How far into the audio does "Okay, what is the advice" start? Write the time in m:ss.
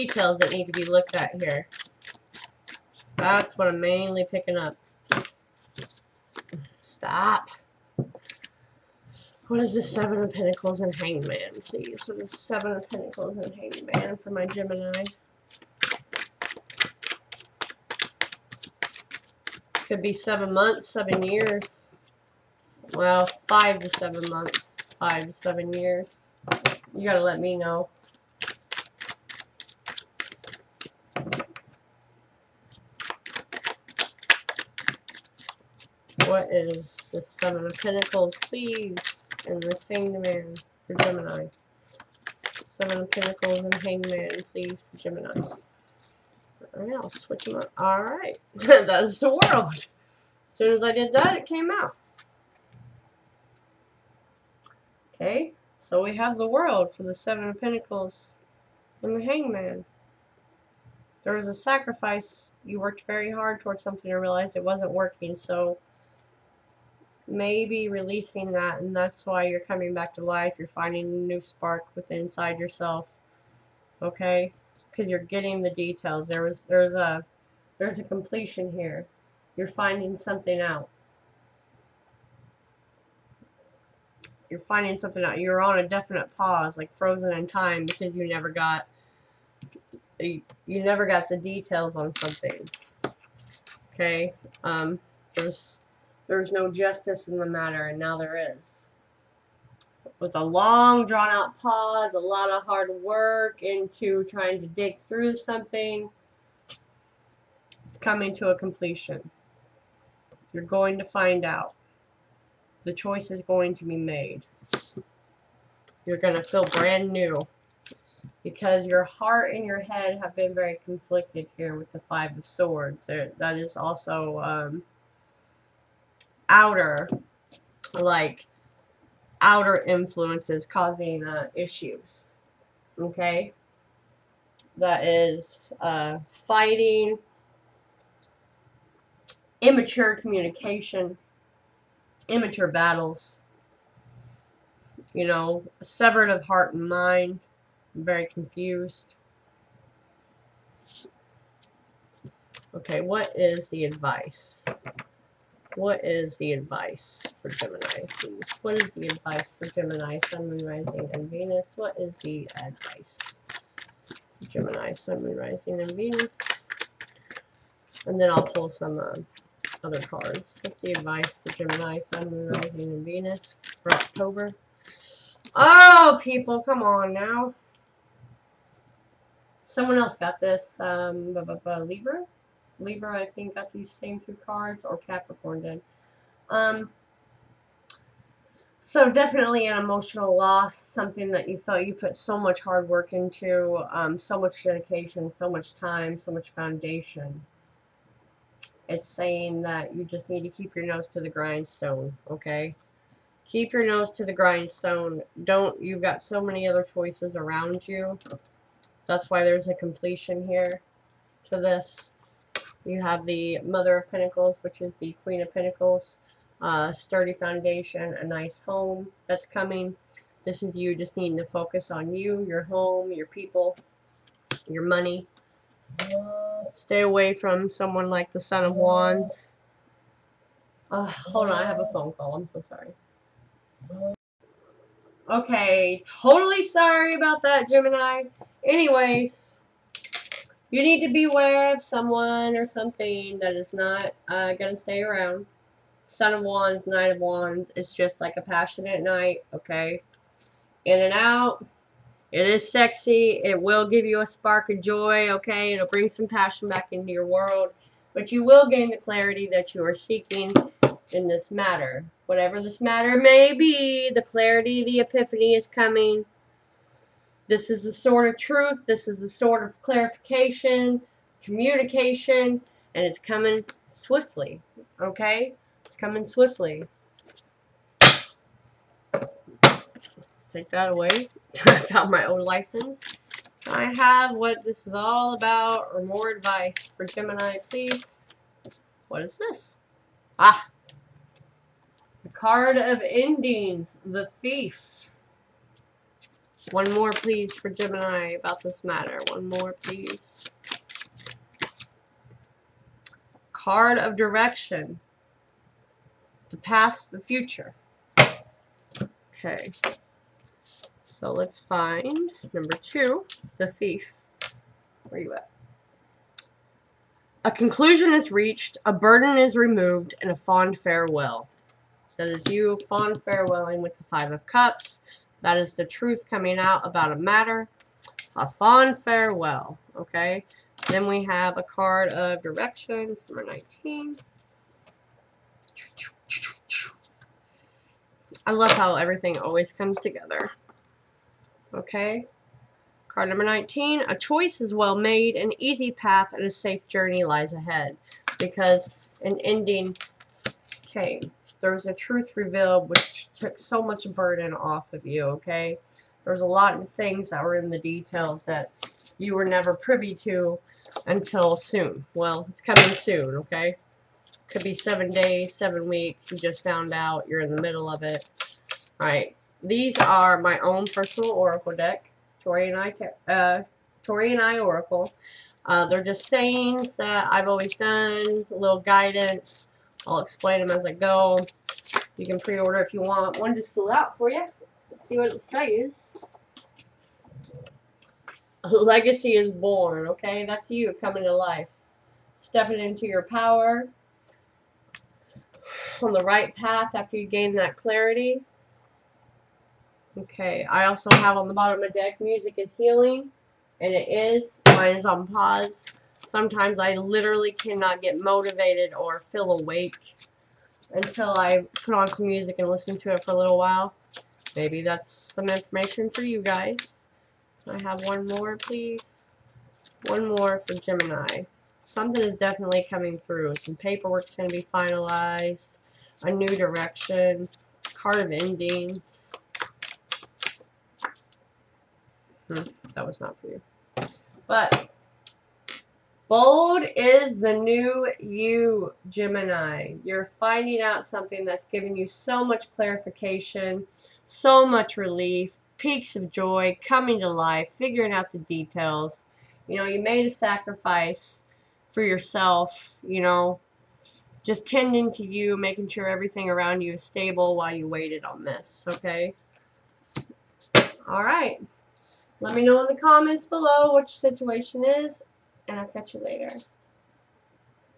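2:32.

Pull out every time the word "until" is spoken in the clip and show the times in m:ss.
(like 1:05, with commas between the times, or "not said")
6:01, 6:50.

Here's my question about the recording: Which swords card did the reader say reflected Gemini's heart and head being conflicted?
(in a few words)
Five of Swords.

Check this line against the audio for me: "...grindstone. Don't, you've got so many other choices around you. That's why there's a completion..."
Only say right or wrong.
right.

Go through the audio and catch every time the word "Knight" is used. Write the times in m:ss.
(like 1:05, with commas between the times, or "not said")
4:06.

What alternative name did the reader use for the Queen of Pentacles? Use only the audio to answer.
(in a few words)
Mother of Pentacles.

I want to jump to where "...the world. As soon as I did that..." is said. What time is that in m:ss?
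0:49.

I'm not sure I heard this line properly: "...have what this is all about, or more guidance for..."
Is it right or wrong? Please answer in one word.
wrong.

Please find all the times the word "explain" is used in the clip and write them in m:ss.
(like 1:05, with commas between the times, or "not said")
6:20.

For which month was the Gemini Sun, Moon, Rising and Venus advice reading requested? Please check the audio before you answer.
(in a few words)
October.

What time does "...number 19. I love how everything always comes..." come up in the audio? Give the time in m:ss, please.
5:33.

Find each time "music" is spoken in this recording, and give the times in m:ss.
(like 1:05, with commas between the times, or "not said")
6:42, 6:52.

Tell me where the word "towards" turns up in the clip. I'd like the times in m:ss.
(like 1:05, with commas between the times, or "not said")
1:03.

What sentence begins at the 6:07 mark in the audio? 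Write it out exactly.
You're in the middle of it.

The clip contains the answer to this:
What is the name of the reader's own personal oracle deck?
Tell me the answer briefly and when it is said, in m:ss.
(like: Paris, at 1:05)
Taurean Eye Oracle, at 6:14.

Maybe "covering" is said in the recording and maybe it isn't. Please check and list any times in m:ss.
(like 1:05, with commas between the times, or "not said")
not said.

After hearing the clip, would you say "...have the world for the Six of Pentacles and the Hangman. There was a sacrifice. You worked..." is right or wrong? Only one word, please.
wrong.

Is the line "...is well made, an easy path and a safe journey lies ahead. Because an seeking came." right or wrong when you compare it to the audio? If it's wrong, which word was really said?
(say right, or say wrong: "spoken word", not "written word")
wrong: "ending", not "seeking".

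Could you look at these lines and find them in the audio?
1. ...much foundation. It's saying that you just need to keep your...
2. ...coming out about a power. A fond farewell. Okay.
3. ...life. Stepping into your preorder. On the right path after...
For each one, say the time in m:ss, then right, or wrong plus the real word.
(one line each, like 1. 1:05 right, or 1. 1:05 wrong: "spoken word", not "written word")
1. 3:16 right
2. 5:26 wrong: "matter", not "power"
3. 6:31 wrong: "power", not "preorder".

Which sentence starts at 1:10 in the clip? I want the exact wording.
You're finding a new spark within inside yourself.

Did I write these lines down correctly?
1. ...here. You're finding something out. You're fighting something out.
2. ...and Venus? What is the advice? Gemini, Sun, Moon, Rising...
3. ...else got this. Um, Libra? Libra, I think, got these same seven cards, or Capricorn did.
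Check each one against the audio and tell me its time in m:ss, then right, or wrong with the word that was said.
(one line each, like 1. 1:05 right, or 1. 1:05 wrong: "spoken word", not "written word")
1. 1:18 wrong: "finding", not "fighting"
2. 2:41 right
3. 2:59 wrong: "two", not "seven".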